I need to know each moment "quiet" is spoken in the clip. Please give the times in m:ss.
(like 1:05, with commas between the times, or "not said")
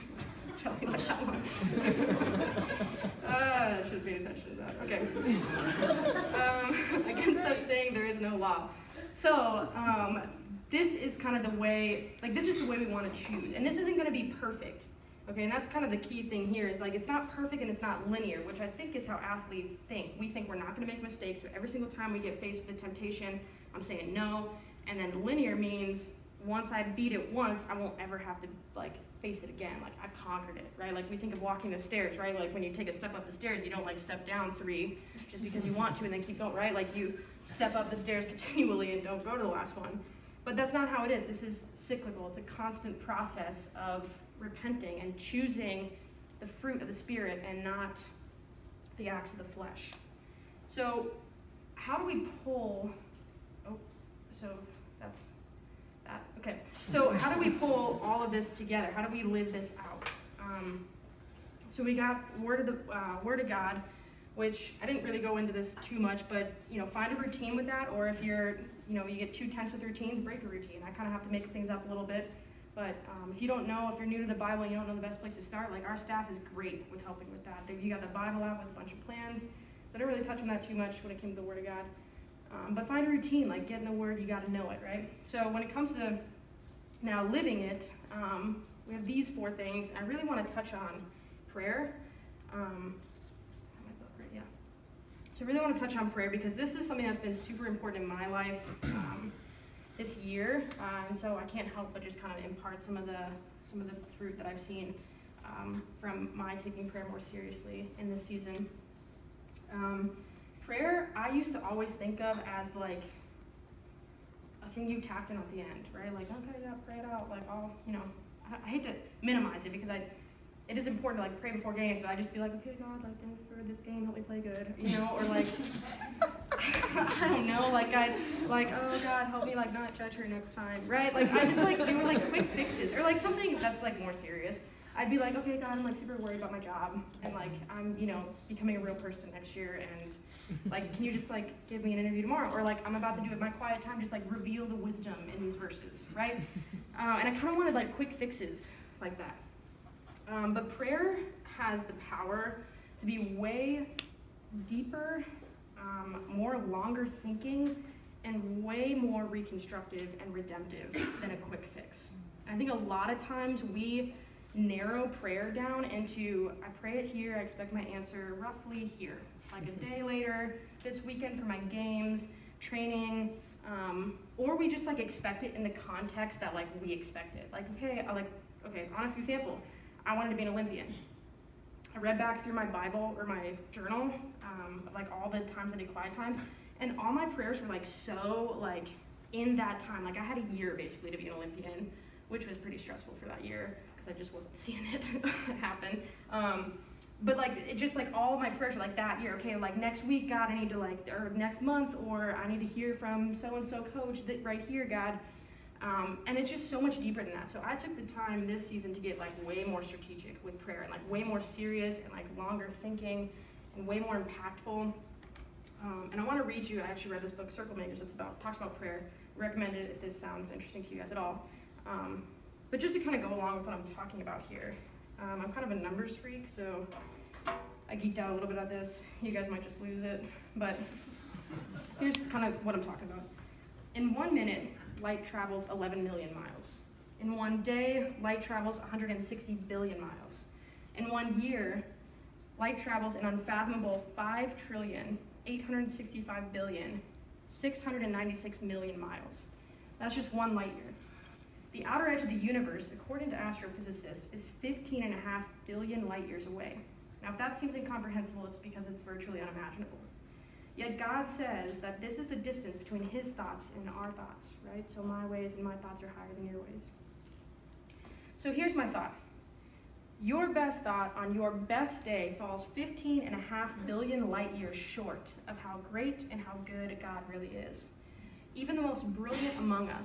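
2:23, 3:05.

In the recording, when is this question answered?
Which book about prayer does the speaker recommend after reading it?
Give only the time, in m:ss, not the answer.
3:37.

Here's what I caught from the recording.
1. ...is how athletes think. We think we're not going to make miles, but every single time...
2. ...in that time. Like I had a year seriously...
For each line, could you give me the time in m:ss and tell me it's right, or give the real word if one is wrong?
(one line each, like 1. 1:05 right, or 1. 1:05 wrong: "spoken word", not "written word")
1. 0:18 wrong: "mistakes", not "miles"
2. 3:09 wrong: "basically", not "seriously".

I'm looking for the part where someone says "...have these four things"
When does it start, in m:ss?
1:28.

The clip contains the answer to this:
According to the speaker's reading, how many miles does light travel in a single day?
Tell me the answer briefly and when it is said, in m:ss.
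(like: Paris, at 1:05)
160 billion miles, at 3:58.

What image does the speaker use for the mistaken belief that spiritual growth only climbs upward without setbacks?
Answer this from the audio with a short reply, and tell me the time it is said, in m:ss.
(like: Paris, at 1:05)
Walking the stairs, at 0:31.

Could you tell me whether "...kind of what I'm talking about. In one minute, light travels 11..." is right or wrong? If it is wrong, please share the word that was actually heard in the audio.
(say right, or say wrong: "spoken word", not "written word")
right.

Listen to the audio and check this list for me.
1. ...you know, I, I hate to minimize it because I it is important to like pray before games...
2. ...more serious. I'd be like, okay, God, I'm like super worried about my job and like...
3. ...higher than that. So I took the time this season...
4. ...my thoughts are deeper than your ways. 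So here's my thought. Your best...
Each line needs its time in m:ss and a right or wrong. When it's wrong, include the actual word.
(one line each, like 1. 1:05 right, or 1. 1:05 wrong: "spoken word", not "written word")
1. 1:57 right
2. 2:13 right
3. 3:26 wrong: "deeper", not "higher"
4. 4:25 wrong: "higher", not "deeper".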